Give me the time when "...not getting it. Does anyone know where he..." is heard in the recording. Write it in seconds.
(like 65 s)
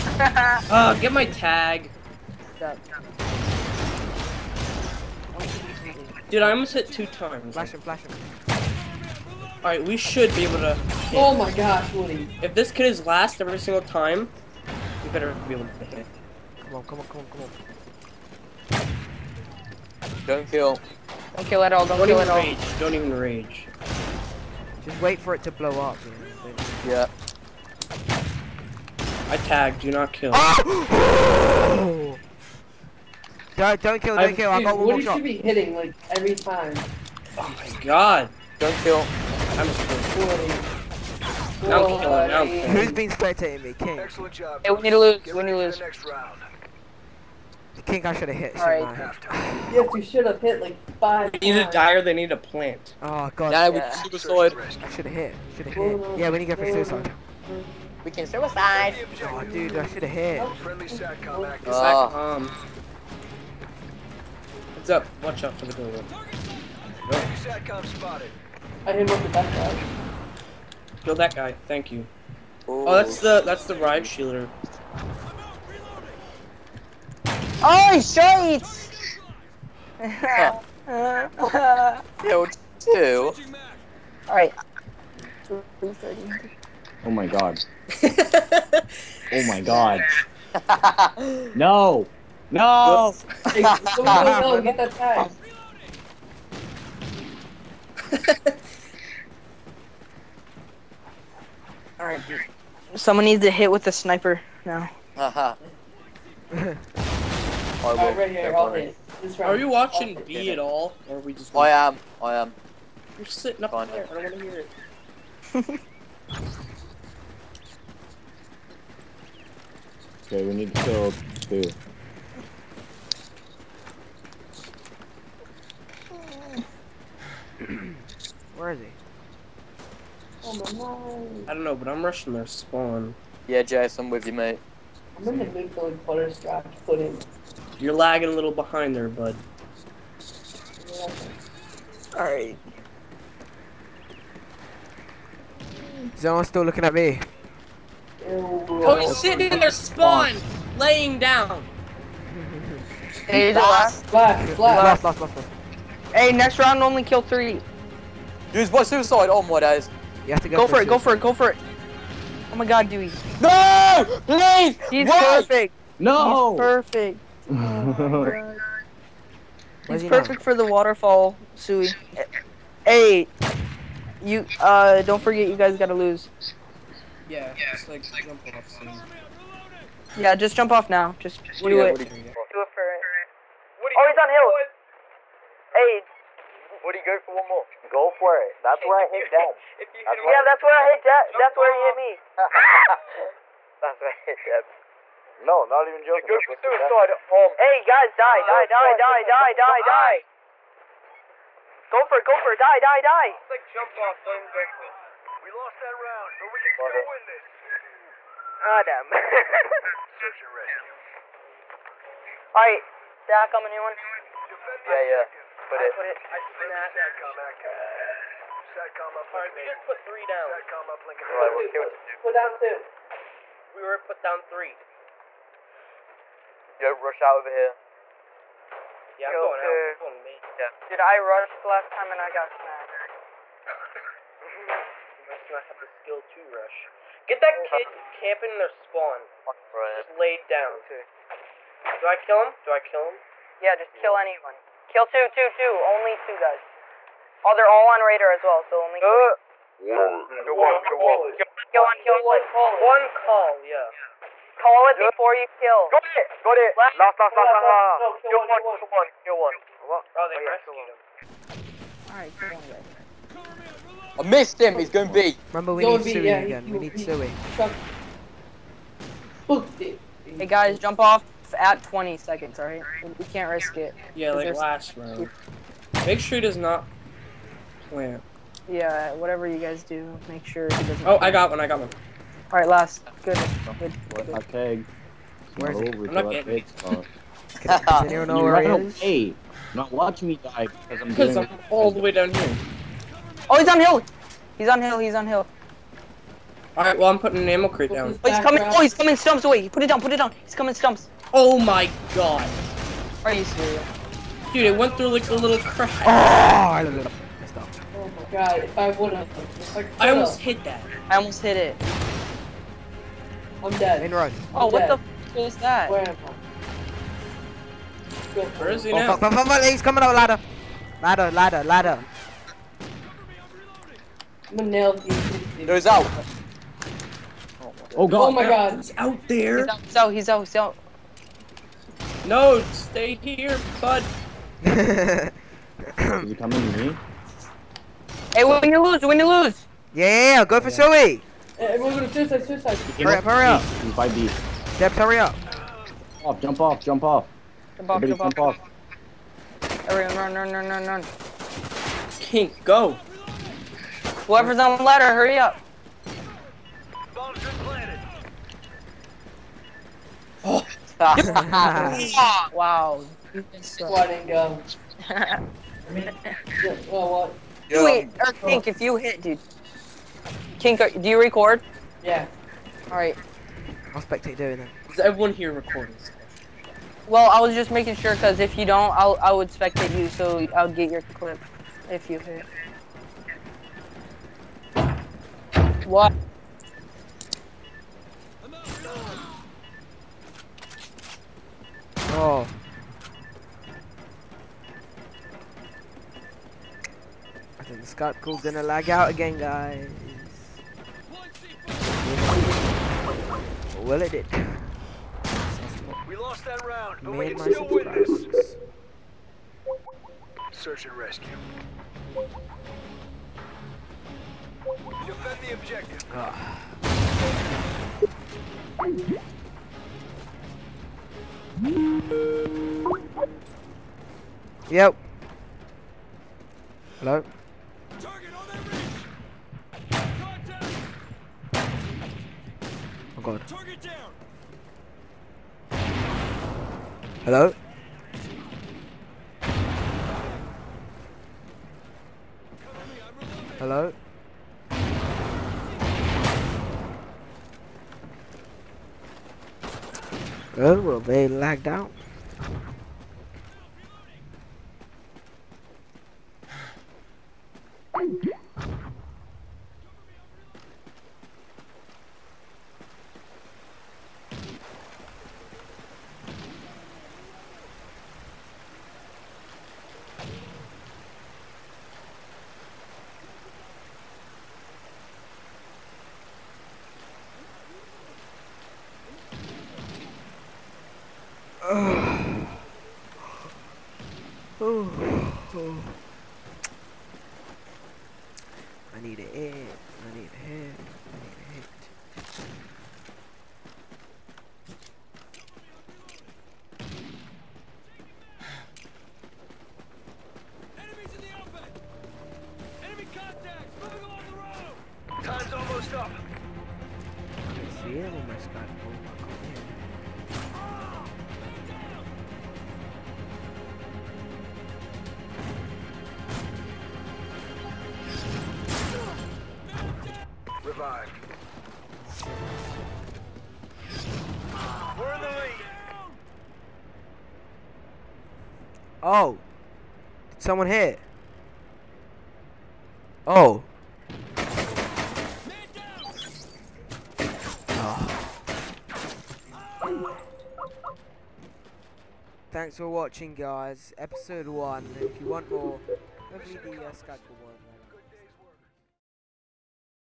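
286 s.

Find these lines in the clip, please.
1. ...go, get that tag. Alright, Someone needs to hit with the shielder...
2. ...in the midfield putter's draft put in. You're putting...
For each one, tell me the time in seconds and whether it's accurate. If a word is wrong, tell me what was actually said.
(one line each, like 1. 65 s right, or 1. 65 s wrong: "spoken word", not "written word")
1. 94 s wrong: "sniper", not "shielder"
2. 135 s wrong: "lagging", not "putting".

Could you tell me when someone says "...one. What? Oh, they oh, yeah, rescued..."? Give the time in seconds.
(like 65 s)
259 s.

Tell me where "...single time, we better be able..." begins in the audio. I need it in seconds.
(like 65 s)
13 s.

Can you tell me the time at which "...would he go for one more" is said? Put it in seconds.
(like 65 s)
186 s.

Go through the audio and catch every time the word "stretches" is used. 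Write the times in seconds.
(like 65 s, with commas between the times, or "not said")
not said.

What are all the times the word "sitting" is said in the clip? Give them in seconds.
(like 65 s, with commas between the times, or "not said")
113 s, 149 s.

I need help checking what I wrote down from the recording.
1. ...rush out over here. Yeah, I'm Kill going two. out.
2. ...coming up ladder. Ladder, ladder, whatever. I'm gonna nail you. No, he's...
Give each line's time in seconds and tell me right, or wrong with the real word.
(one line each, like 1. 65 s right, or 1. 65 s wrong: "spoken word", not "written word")
1. 226 s right
2. 319 s wrong: "ladder", not "whatever".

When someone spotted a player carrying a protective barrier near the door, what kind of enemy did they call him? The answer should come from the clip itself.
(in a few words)
riot shielder.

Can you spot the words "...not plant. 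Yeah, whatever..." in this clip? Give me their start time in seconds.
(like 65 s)
276 s.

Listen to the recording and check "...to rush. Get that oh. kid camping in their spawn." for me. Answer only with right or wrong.
right.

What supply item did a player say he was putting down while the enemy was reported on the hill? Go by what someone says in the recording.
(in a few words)
ammo crate.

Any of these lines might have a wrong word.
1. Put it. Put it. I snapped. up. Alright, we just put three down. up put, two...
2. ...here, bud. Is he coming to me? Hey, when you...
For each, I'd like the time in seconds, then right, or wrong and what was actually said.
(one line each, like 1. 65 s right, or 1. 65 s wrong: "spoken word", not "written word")
1. 215 s right
2. 333 s right.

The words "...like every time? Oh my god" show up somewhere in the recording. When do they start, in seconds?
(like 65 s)
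35 s.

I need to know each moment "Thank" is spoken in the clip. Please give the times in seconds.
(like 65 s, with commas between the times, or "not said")
71 s, 542 s.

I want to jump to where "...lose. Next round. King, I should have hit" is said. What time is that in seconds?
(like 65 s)
45 s.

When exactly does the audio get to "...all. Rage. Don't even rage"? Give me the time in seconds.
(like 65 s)
22 s.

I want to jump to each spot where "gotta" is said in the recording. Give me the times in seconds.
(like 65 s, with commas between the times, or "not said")
175 s.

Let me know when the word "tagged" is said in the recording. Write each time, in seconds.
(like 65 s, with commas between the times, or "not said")
29 s.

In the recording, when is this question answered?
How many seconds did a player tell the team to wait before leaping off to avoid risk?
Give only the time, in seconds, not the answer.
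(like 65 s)
271 s.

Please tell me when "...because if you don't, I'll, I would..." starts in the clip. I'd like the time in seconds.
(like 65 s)
378 s.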